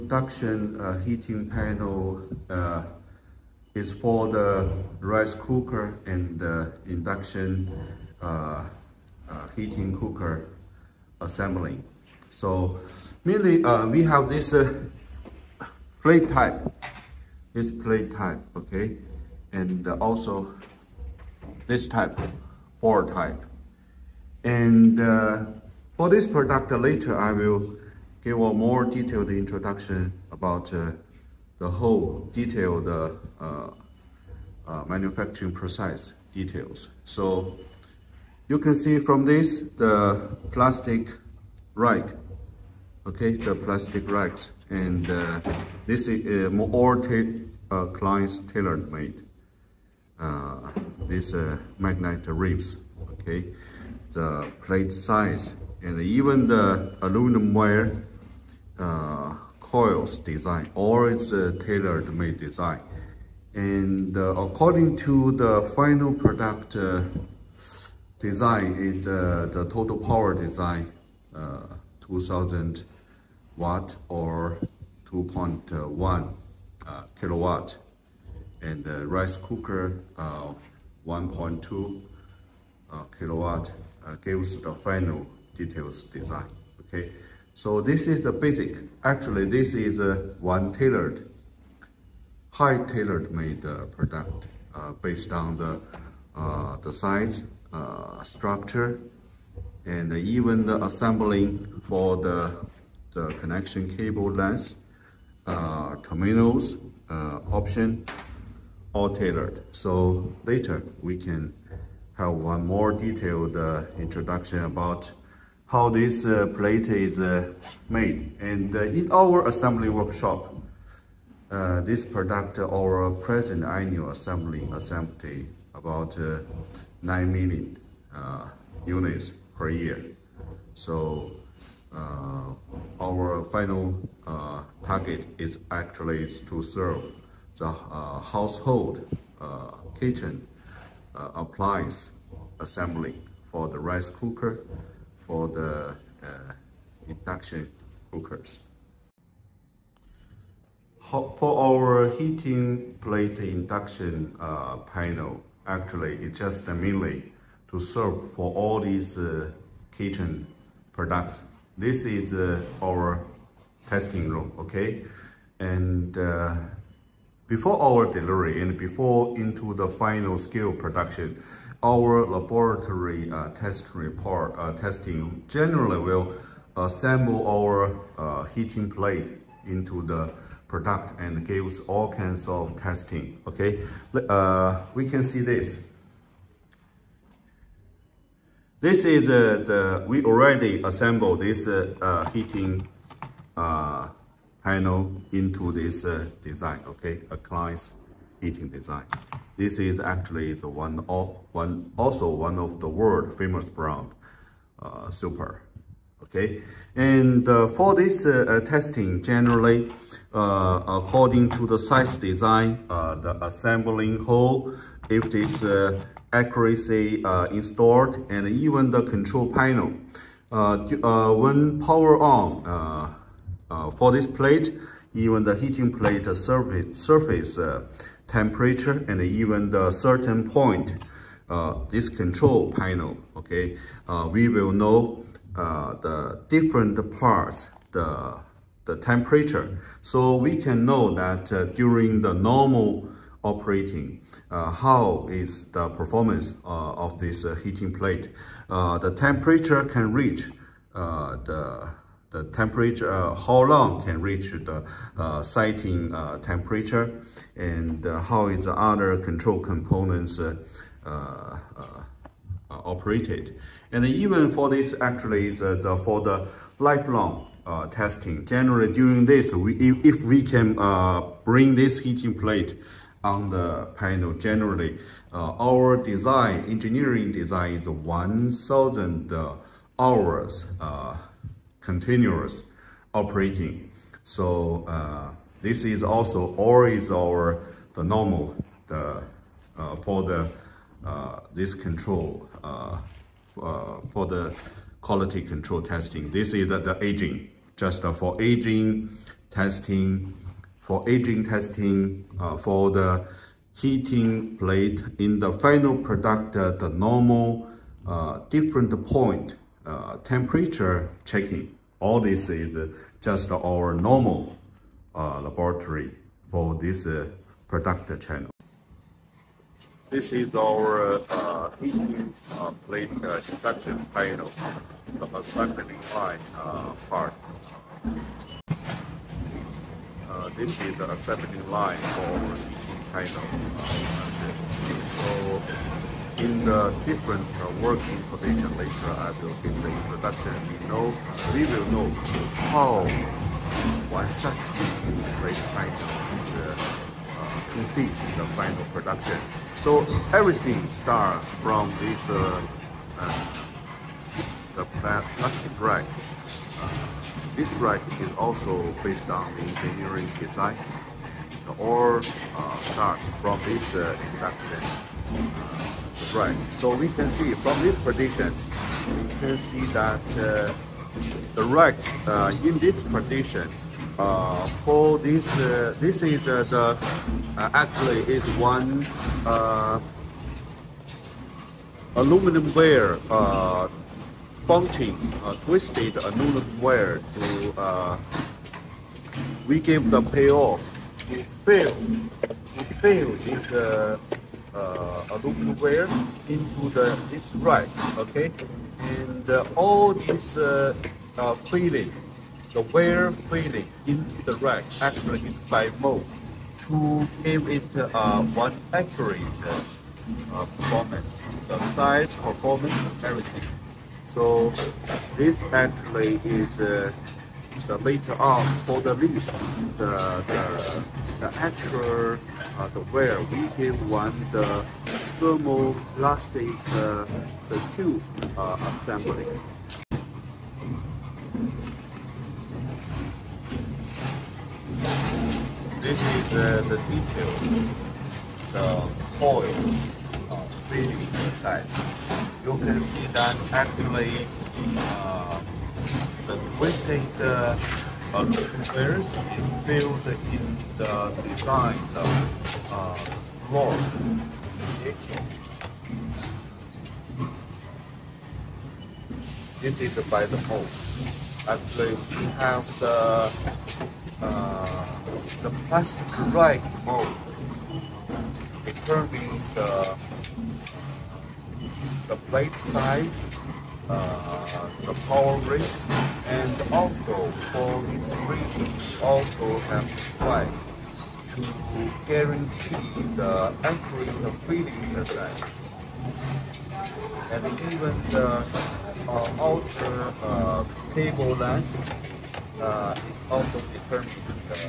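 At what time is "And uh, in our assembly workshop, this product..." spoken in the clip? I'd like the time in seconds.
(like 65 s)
118 s.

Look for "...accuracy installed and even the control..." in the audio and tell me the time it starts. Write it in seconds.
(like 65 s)
216 s.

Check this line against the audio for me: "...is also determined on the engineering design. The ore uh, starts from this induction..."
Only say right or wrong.
wrong.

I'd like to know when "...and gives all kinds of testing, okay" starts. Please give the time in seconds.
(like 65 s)
181 s.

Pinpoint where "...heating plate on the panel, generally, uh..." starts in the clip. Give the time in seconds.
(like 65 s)
271 s.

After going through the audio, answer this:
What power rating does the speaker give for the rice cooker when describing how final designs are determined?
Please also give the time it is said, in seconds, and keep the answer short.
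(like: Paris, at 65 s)
1.2 kilowatt, at 81 s.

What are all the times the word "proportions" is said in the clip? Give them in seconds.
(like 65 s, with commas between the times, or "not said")
not said.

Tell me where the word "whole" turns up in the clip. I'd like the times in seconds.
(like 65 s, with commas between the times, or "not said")
31 s.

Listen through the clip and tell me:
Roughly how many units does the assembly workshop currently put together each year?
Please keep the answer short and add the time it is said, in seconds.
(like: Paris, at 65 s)
9 million, at 127 s.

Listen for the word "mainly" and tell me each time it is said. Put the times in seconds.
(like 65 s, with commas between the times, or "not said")
13 s, 156 s.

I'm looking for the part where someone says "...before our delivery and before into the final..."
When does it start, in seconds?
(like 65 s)
167 s.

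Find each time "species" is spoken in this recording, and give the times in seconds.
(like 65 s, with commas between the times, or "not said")
not said.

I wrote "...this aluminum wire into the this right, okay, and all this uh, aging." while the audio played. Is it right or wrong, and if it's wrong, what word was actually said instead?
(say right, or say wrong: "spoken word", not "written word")
wrong: "cleaning", not "aging".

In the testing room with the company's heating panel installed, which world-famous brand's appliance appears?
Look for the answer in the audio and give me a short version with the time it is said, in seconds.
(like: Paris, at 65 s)
Supor, at 205 s.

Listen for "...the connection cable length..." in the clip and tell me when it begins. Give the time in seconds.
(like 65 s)
103 s.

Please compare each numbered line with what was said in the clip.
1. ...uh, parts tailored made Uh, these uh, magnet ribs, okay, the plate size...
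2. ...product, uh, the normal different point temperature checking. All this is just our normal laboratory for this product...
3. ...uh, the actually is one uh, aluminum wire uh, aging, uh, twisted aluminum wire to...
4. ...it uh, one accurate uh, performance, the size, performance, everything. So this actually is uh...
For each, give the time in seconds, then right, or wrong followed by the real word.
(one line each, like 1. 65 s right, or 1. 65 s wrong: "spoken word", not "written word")
1. 46 s wrong: "clients", not "parts"
2. 305 s right
3. 376 s wrong: "bunching", not "aging"
4. 407 s right.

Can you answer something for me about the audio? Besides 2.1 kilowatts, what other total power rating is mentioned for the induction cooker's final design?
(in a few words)
2000 watt.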